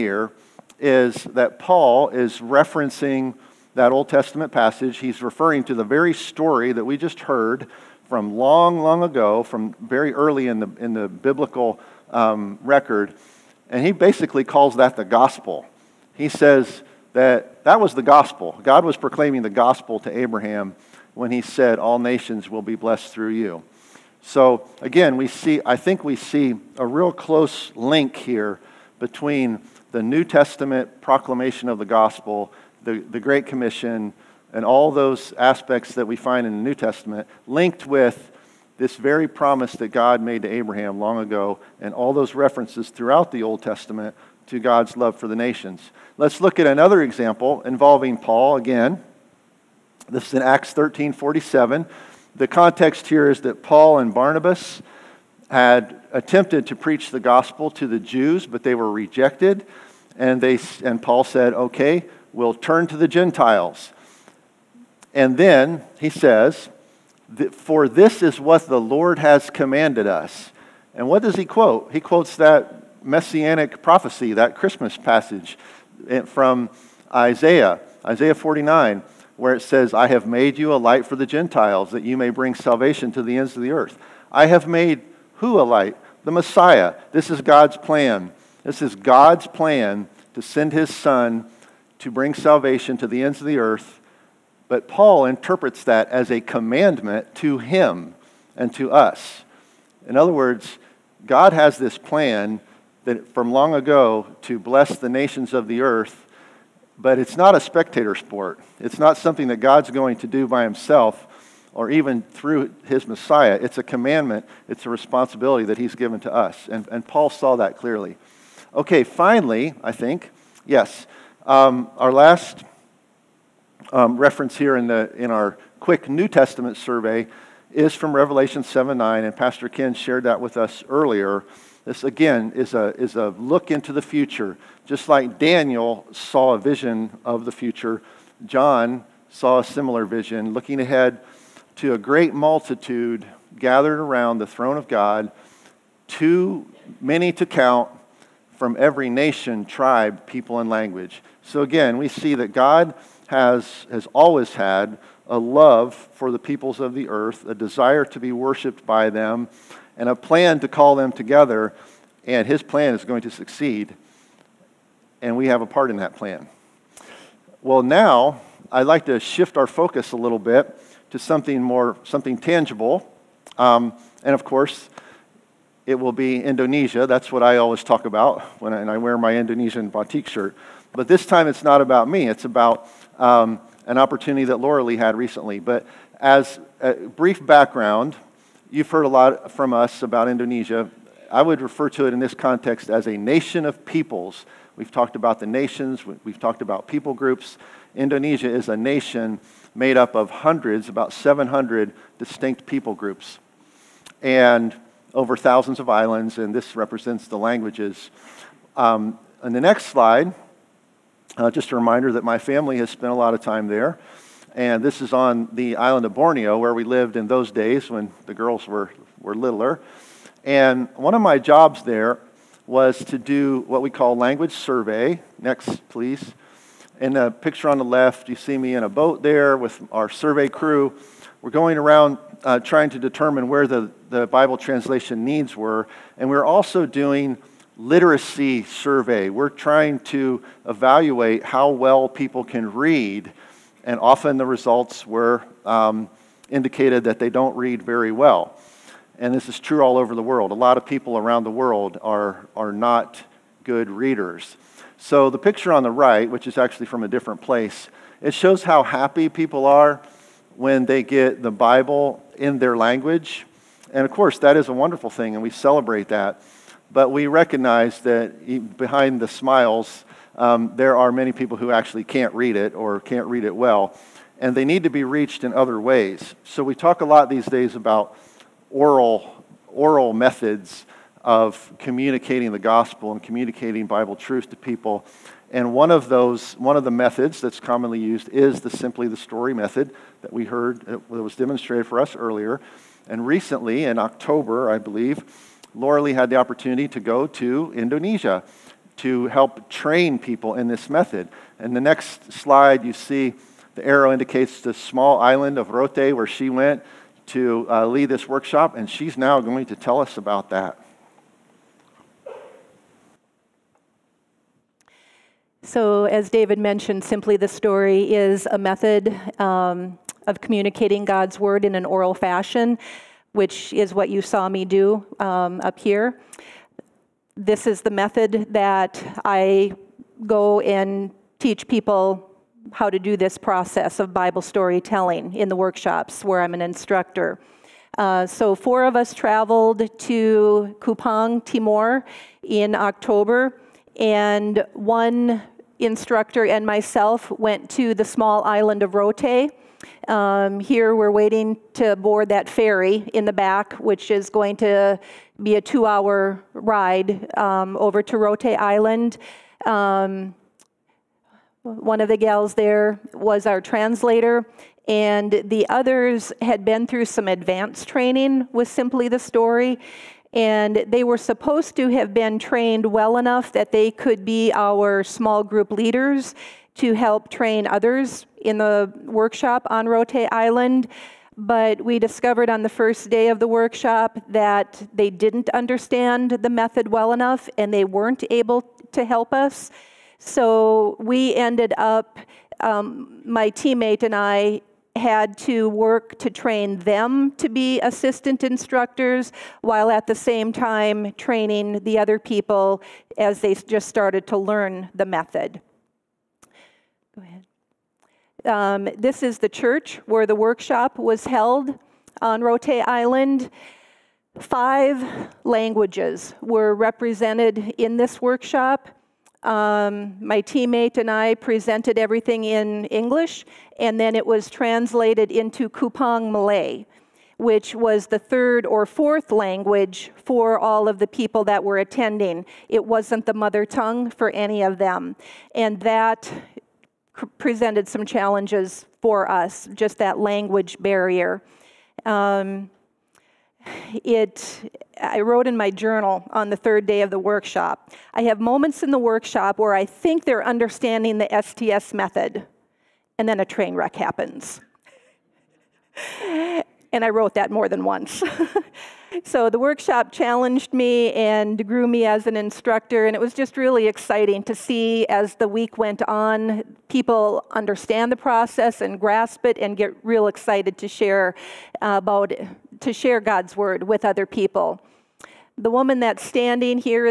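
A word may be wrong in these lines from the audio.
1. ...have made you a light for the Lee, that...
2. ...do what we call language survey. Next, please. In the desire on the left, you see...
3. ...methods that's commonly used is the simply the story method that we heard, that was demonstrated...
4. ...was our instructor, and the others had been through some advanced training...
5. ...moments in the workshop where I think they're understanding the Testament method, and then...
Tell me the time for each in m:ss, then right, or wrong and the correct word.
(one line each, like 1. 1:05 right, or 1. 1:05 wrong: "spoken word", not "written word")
1. 1:20 wrong: "Gentiles", not "Lee"
2. 3:43 wrong: "picture", not "desire"
3. 4:46 right
4. 6:03 wrong: "translator", not "instructor"
5. 7:28 wrong: "STS", not "Testament".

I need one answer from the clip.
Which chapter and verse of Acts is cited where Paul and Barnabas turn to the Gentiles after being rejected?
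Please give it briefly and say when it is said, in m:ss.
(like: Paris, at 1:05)
Acts 13:47, at 0:50.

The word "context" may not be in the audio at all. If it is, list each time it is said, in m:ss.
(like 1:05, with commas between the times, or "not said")
0:52, 3:12.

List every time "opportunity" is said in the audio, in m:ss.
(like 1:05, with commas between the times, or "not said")
3:03, 4:56.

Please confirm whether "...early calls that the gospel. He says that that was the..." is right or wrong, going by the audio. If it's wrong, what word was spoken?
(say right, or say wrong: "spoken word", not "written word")
wrong: "basically", not "early".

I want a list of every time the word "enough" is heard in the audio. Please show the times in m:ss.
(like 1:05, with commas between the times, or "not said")
6:13, 6:27.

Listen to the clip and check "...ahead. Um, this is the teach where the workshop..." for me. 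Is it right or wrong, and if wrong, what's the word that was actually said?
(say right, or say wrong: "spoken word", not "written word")
wrong: "church", not "teach".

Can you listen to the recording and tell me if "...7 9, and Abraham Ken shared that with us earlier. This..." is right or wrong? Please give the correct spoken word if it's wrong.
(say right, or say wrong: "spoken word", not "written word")
wrong: "Pastor", not "Abraham".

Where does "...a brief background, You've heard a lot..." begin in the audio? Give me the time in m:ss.
3:06.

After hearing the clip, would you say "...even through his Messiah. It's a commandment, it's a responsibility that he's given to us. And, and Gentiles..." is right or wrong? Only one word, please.
wrong.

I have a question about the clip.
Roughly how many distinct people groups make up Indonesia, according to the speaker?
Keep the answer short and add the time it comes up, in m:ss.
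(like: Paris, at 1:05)
700, at 3:20.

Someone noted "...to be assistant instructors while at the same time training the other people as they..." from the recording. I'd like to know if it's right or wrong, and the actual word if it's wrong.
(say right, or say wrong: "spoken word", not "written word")
right.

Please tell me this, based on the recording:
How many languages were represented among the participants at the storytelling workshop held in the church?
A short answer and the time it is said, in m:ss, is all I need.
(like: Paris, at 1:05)
5, at 6:54.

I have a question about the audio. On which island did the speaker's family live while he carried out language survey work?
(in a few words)
Borneo.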